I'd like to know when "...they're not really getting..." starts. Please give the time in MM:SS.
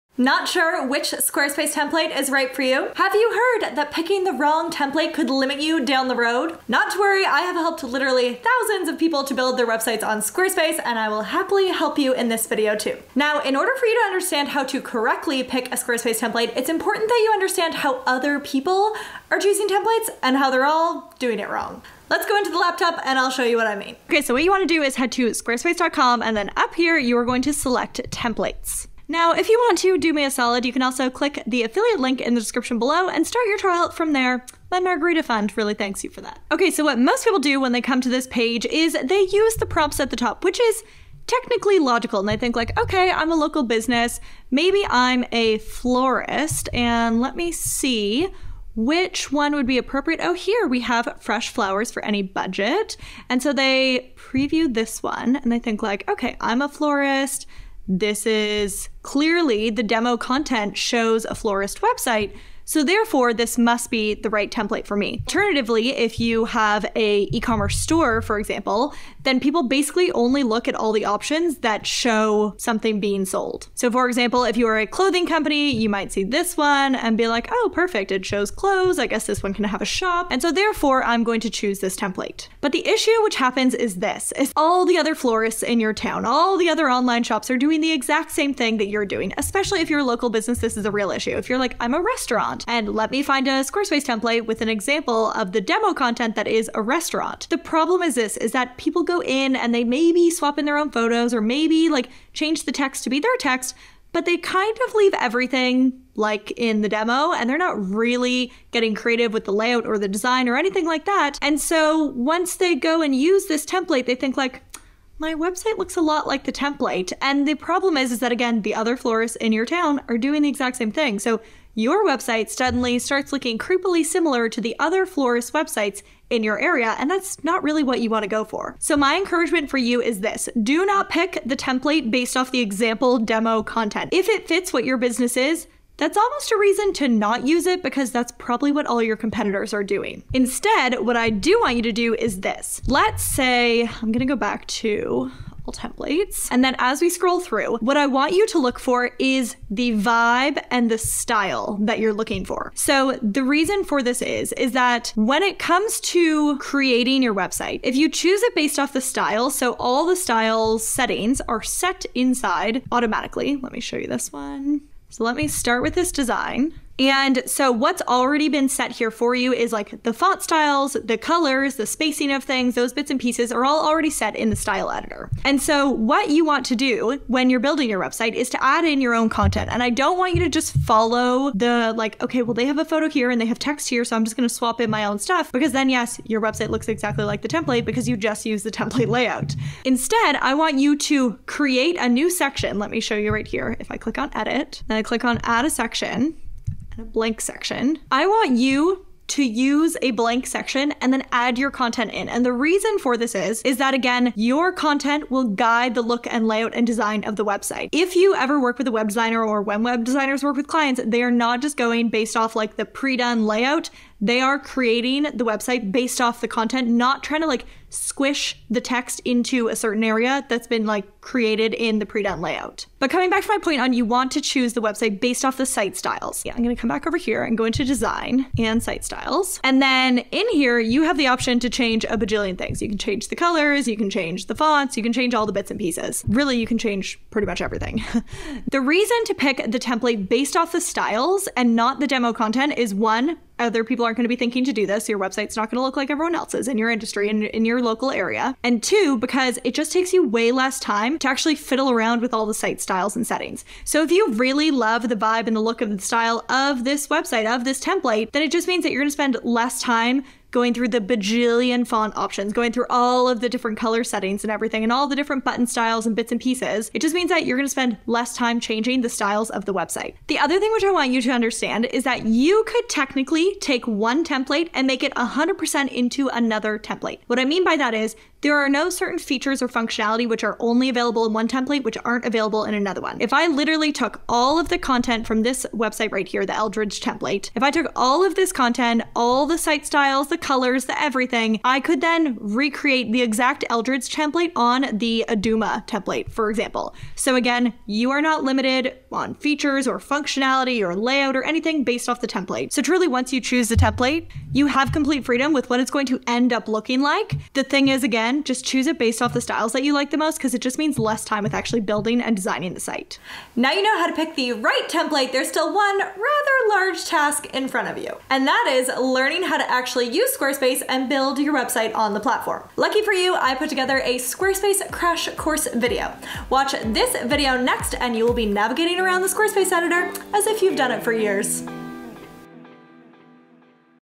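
01:47.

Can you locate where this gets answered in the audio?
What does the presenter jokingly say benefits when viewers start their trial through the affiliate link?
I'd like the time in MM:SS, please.
00:34.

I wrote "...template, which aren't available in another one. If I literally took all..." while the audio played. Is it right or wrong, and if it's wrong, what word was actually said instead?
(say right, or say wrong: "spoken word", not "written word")
right.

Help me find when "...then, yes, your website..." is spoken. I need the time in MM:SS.
03:05.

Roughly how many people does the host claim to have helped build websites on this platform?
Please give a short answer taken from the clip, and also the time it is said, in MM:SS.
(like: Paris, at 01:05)
thousands, at 00:08.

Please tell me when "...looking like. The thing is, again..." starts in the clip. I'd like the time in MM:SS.
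05:06.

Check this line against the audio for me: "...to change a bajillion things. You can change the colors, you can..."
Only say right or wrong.
right.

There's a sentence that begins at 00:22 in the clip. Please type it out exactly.
Let's go into the laptop and I'll show you what I mean.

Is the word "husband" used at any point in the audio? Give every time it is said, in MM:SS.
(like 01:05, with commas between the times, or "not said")
not said.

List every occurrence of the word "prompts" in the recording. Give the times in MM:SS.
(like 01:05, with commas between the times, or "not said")
00:39.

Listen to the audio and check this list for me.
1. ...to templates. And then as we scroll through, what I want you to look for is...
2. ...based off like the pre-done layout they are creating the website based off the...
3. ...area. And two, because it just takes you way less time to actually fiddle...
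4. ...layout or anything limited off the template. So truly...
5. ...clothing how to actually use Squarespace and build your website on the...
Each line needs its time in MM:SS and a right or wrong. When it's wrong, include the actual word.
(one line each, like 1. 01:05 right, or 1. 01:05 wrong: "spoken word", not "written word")
1. 02:24 right
2. 03:32 right
3. 04:08 right
4. 05:00 wrong: "based", not "limited"
5. 05:18 wrong: "learning", not "clothing".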